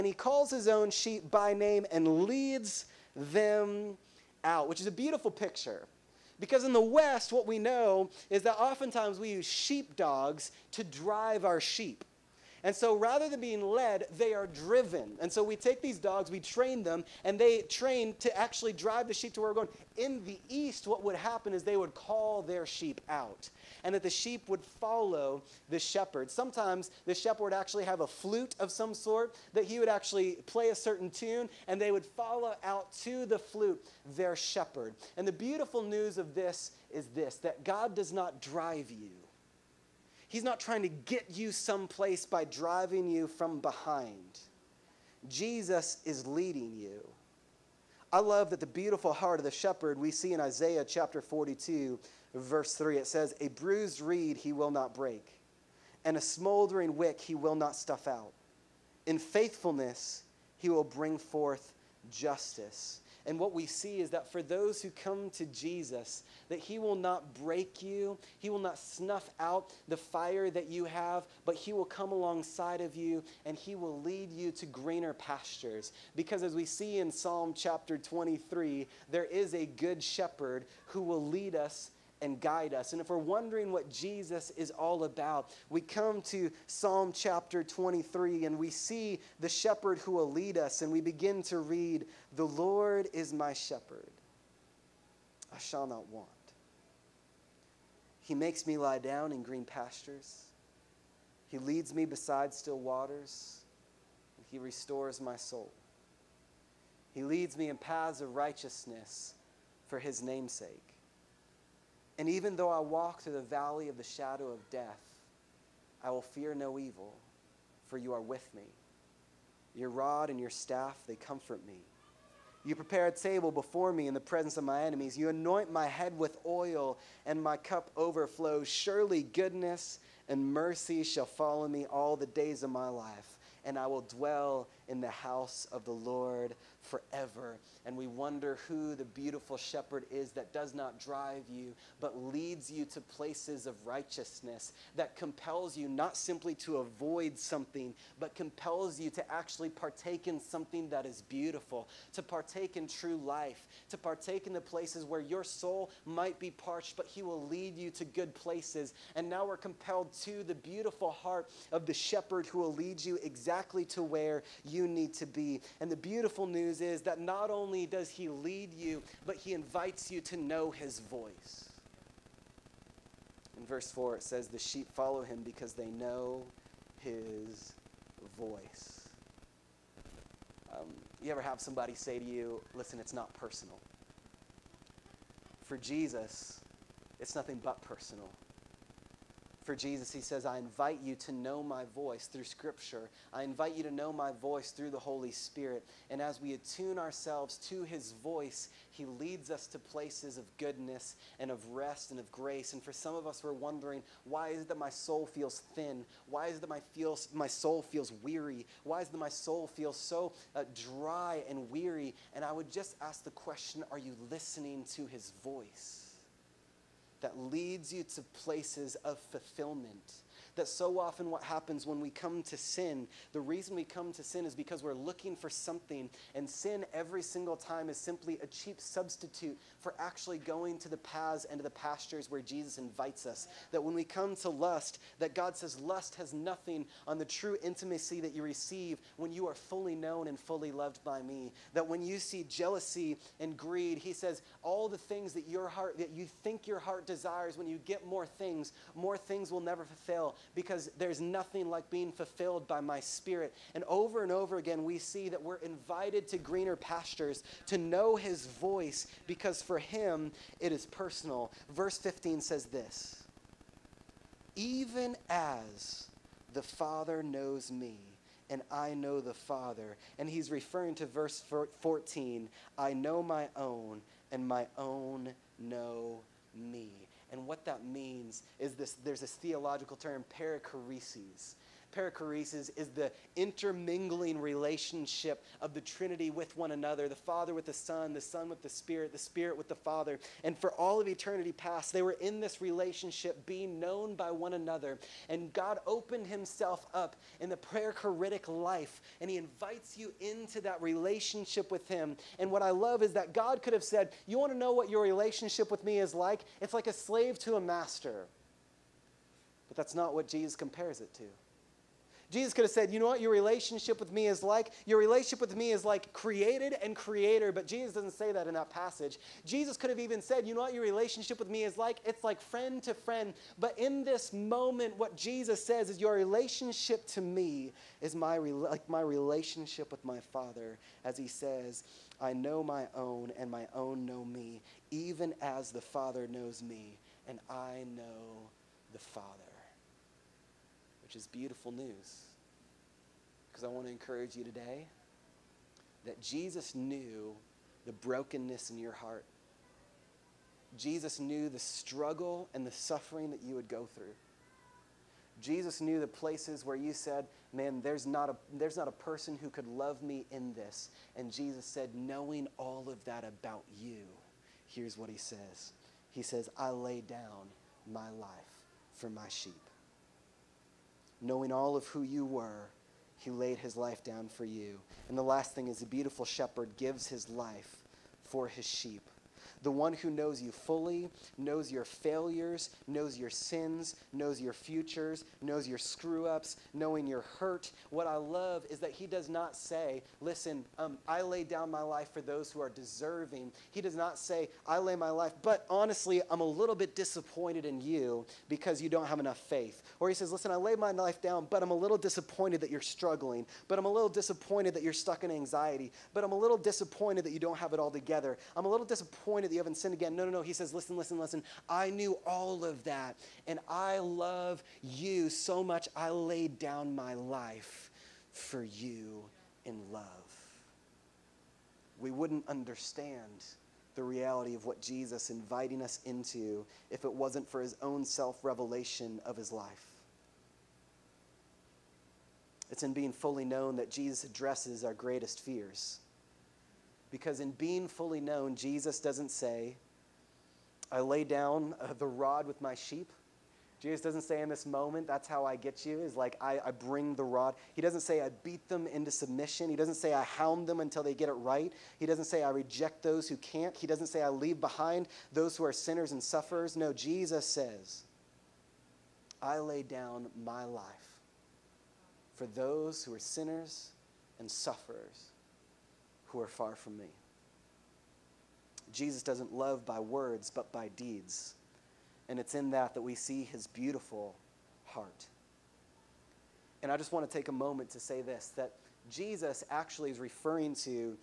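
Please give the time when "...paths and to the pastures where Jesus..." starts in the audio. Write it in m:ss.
3:50.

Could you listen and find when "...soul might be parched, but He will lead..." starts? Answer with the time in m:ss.
2:35.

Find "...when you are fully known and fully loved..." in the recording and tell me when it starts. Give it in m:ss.
3:59.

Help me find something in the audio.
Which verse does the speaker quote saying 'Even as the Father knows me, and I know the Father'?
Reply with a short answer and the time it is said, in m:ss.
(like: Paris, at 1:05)
Verse 15, at 4:21.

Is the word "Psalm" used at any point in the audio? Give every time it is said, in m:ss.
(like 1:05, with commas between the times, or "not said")
1:17, 1:26.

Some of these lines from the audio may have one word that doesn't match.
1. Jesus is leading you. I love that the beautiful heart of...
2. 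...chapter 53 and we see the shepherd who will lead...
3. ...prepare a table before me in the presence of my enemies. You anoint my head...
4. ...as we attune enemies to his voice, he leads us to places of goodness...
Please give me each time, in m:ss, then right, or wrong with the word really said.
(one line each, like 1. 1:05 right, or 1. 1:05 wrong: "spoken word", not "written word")
1. 0:45 right
2. 1:27 wrong: "23", not "53"
3. 2:02 right
4. 3:16 wrong: "ourselves", not "enemies".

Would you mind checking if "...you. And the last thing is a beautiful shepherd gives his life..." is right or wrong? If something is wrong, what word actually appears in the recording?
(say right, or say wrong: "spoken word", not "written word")
right.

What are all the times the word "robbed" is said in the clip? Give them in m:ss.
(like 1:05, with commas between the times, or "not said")
not said.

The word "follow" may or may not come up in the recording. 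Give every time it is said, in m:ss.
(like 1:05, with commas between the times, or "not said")
0:24, 0:32, 2:11, 2:54.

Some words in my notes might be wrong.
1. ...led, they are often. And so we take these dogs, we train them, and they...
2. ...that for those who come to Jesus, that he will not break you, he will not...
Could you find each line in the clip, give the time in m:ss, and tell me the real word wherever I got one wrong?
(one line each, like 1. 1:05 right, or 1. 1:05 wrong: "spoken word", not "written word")
1. 0:13 wrong: "driven", not "often"
2. 1:04 right.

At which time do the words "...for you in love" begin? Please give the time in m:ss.
6:58.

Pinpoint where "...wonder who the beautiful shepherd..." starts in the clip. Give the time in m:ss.
2:18.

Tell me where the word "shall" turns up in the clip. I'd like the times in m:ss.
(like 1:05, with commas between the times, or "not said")
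1:35, 2:11.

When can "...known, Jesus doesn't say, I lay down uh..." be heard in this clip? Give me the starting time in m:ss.
7:18.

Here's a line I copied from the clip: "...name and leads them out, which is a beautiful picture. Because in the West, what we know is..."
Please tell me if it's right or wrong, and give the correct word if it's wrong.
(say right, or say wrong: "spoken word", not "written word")
right.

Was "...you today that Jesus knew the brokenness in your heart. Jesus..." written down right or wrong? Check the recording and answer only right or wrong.
right.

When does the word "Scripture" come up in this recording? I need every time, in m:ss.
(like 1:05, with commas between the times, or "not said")
3:12.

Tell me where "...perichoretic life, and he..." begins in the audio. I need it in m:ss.
4:57.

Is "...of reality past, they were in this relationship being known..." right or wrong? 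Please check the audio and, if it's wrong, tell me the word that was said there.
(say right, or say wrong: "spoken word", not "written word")
wrong: "eternity", not "reality".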